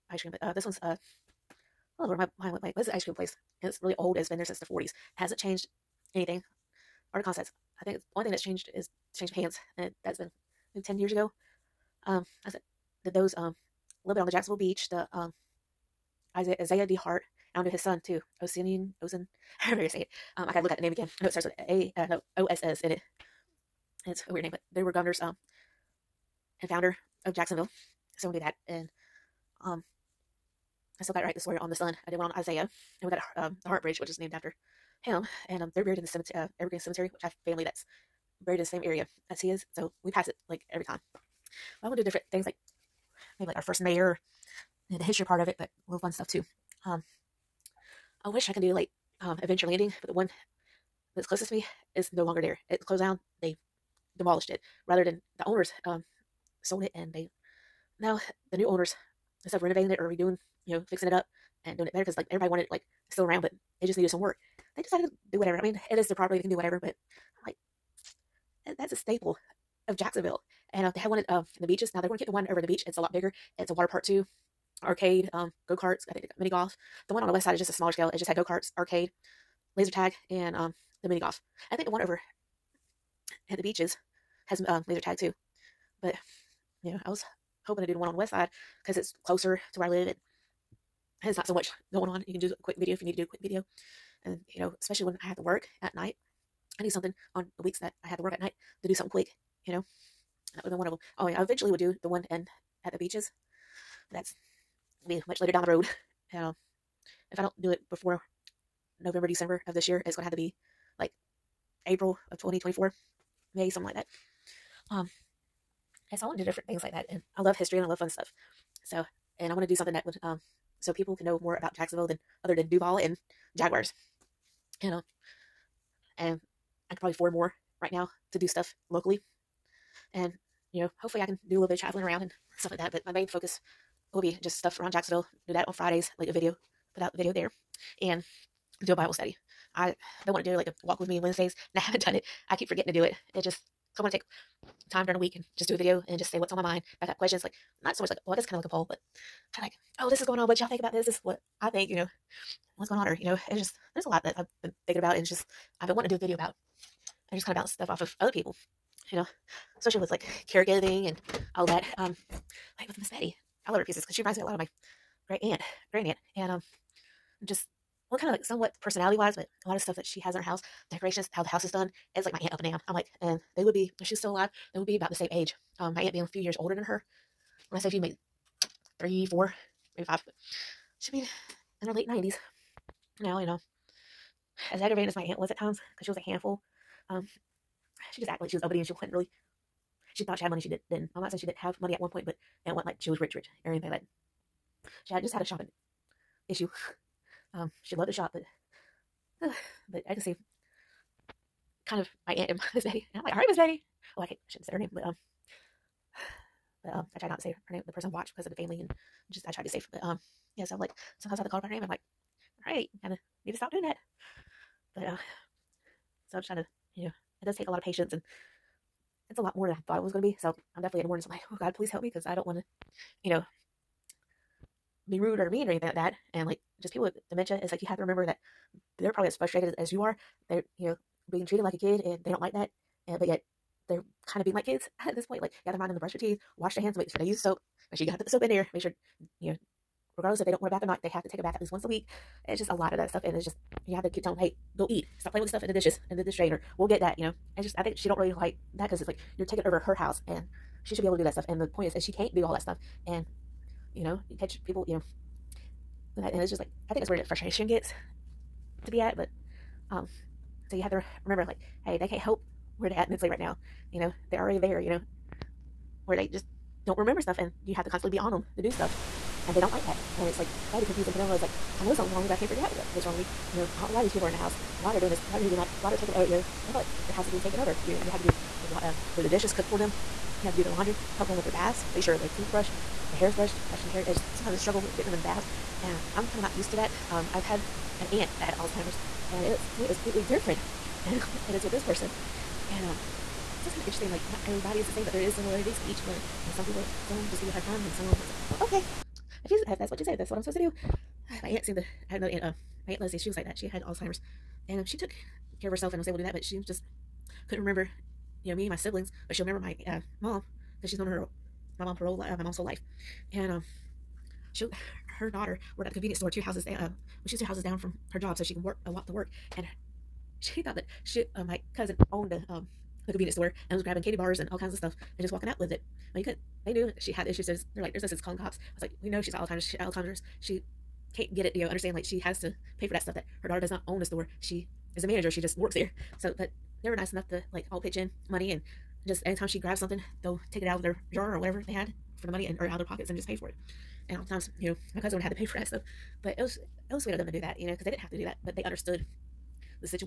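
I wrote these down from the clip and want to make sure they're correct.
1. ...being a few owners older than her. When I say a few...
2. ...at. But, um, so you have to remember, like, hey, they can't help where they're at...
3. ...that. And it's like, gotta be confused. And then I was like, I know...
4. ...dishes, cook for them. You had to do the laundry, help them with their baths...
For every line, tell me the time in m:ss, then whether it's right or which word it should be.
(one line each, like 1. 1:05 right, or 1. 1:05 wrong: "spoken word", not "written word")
1. 2:56 wrong: "years", not "owners"
2. 4:18 right
3. 4:29 right
4. 4:39 right.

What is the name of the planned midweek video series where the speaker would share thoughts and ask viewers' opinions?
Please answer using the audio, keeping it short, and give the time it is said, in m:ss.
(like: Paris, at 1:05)
Walk With Me Wednesdays, at 2:20.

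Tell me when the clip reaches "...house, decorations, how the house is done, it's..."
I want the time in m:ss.
2:50.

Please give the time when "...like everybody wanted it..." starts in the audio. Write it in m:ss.
1:02.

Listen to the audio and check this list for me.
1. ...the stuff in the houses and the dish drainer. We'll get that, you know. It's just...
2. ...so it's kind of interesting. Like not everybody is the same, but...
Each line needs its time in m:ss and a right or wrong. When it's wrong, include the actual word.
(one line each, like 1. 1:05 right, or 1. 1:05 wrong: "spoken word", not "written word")
1. 4:05 wrong: "dishes", not "houses"
2. 4:53 right.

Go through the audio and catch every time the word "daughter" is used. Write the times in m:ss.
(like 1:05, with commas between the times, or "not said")
5:15, 5:33.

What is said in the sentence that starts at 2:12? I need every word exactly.
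But my main focus will be just stuff around Jacksonville.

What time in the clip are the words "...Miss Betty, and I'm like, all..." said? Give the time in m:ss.
3:22.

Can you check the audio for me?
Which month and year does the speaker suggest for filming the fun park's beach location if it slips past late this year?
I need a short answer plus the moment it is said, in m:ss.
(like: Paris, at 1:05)
April 2024, at 1:51.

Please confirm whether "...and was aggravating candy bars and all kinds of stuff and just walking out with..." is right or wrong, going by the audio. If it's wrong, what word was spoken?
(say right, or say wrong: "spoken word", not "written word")
wrong: "grabbing", not "aggravating".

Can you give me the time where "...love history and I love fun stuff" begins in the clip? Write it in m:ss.
1:57.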